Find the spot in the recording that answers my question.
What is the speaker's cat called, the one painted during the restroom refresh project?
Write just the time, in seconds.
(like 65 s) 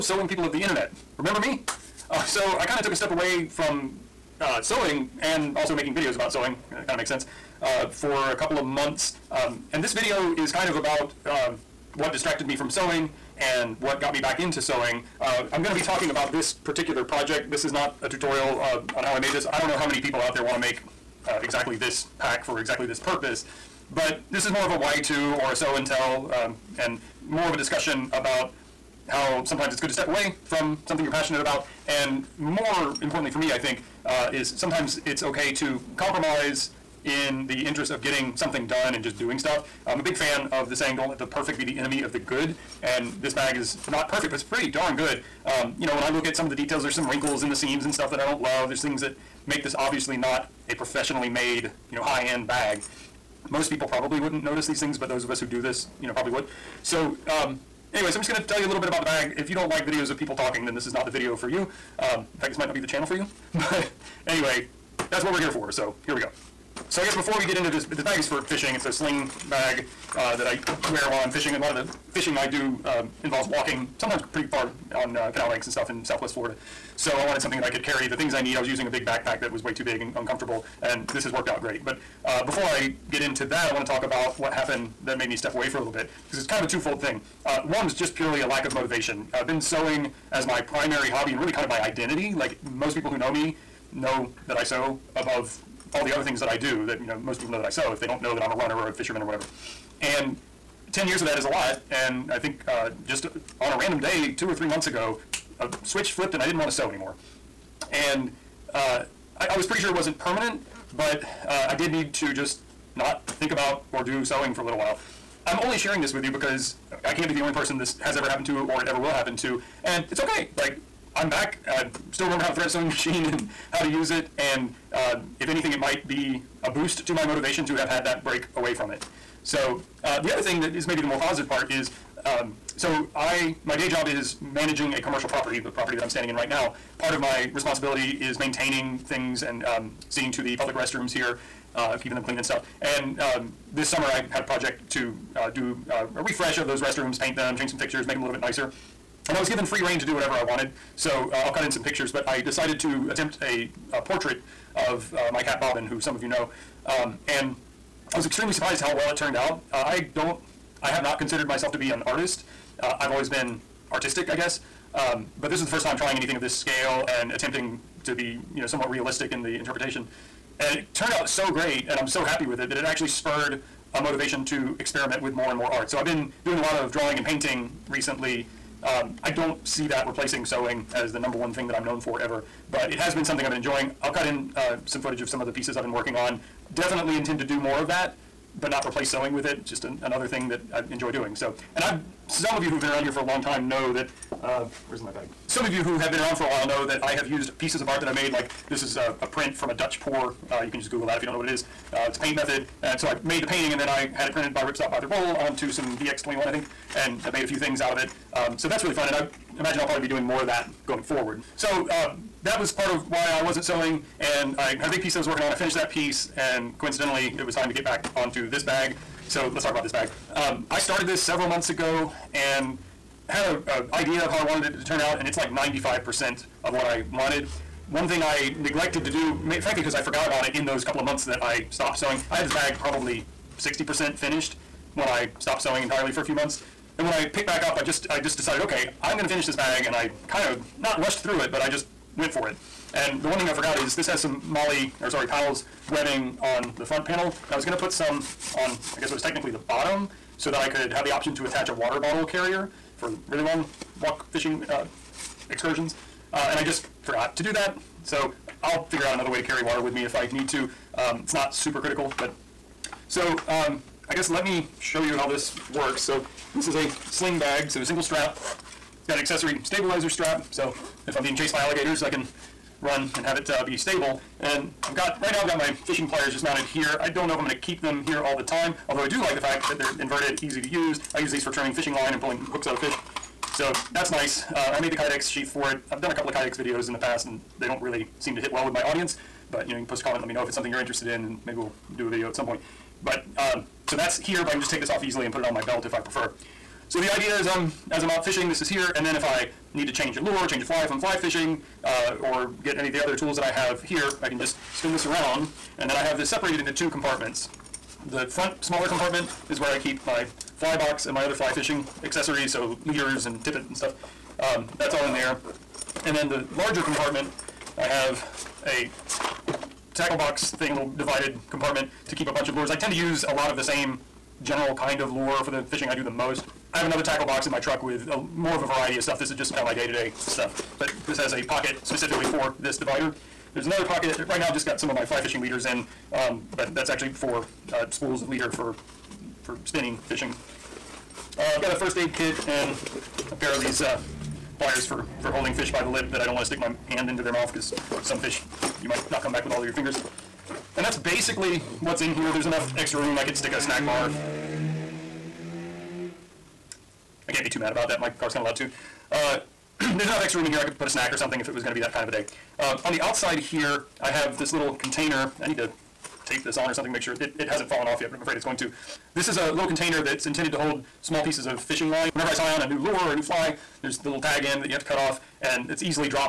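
155 s.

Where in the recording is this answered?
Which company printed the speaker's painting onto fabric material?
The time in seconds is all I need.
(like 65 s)
204 s.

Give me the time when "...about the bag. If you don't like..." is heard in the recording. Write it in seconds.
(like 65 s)
58 s.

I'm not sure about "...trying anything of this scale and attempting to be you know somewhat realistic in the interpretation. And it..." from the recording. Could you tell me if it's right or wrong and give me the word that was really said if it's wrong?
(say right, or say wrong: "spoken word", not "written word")
right.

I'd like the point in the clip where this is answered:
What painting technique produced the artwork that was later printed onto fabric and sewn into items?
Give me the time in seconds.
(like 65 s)
199 s.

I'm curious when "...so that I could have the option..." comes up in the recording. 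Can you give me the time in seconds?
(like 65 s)
250 s.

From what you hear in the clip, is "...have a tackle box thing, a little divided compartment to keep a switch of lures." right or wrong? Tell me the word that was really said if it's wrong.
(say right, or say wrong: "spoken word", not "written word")
wrong: "bunch", not "switch".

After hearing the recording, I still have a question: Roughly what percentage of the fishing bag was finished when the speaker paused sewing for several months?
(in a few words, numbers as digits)
60%.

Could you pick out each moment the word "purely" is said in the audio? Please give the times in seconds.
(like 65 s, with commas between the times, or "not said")
88 s.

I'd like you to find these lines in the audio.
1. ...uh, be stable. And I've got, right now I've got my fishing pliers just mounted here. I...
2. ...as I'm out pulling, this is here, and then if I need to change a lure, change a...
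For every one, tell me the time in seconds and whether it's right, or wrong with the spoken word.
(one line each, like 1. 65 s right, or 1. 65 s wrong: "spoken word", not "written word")
1. 273 s right
2. 297 s wrong: "fishing", not "pulling".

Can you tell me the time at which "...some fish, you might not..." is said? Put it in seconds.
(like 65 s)
348 s.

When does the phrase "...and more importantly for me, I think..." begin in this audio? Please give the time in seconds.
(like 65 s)
31 s.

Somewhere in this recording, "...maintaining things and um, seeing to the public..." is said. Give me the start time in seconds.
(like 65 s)
138 s.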